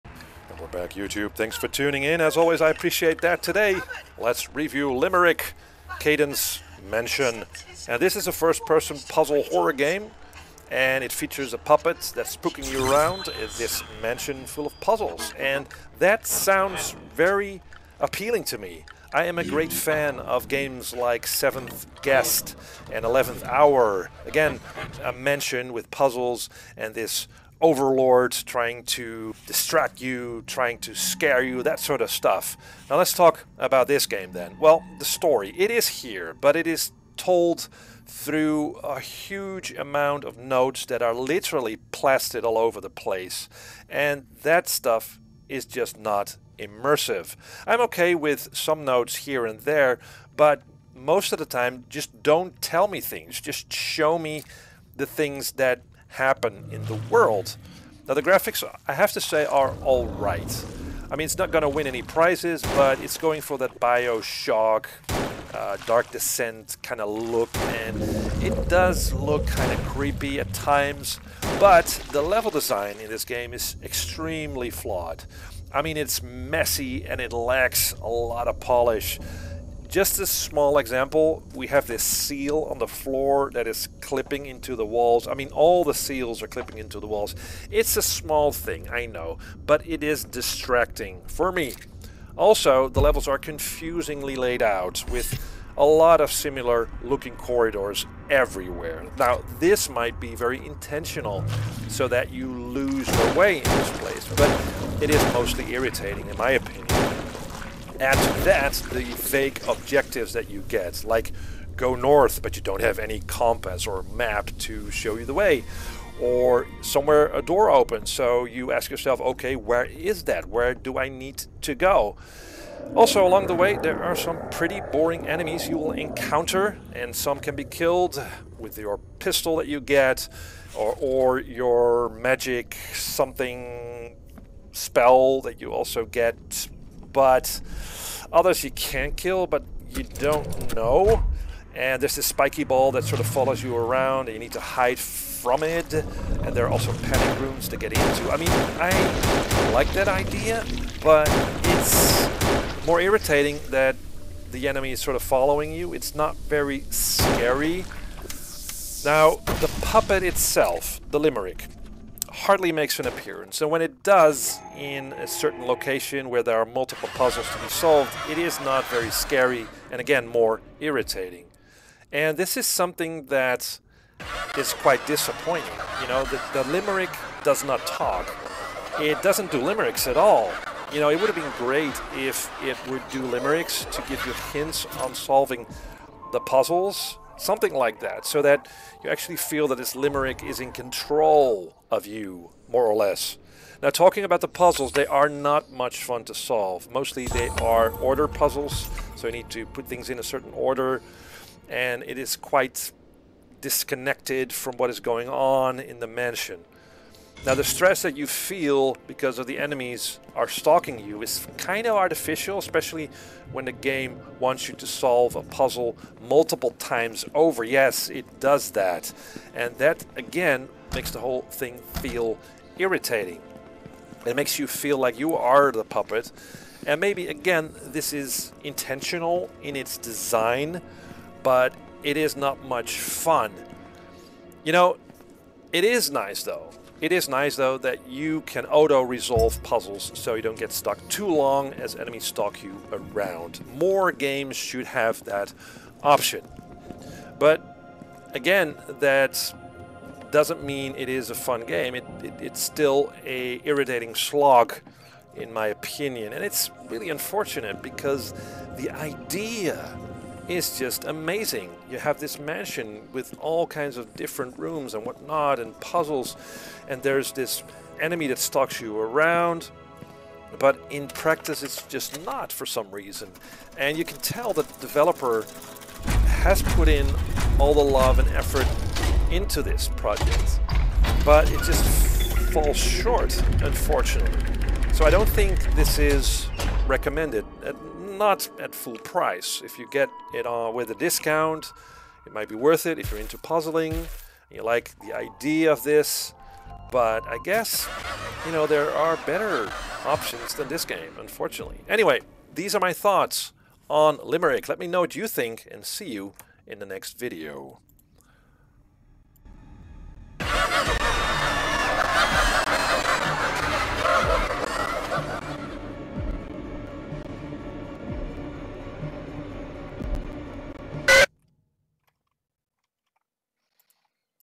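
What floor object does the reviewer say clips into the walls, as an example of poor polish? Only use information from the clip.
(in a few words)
seal.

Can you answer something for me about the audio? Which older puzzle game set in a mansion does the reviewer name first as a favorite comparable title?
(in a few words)
Seventh Guest.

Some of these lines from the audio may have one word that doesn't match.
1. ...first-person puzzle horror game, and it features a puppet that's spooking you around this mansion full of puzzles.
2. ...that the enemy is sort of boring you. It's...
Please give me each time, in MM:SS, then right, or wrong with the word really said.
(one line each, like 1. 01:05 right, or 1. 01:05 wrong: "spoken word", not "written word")
1. 00:08 right
2. 02:33 wrong: "following", not "boring".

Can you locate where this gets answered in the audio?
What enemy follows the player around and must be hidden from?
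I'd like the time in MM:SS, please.
02:22.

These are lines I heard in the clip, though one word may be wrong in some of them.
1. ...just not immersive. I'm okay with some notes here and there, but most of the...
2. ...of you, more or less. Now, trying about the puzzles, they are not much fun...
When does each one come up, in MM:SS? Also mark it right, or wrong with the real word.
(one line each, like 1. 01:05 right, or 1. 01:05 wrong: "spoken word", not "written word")
1. 00:45 right
2. 03:11 wrong: "talking", not "trying".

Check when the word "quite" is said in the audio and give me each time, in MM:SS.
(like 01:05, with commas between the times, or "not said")
02:54, 03:22.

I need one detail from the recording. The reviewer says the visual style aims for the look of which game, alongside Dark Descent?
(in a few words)
Bioshock.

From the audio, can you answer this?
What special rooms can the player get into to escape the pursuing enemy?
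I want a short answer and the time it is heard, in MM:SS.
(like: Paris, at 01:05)
panic rooms, at 02:27.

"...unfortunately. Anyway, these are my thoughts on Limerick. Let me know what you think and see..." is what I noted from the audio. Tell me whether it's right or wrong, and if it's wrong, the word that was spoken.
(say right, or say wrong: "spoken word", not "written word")
right.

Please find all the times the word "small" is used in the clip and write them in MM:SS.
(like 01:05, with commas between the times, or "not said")
01:20, 01:28.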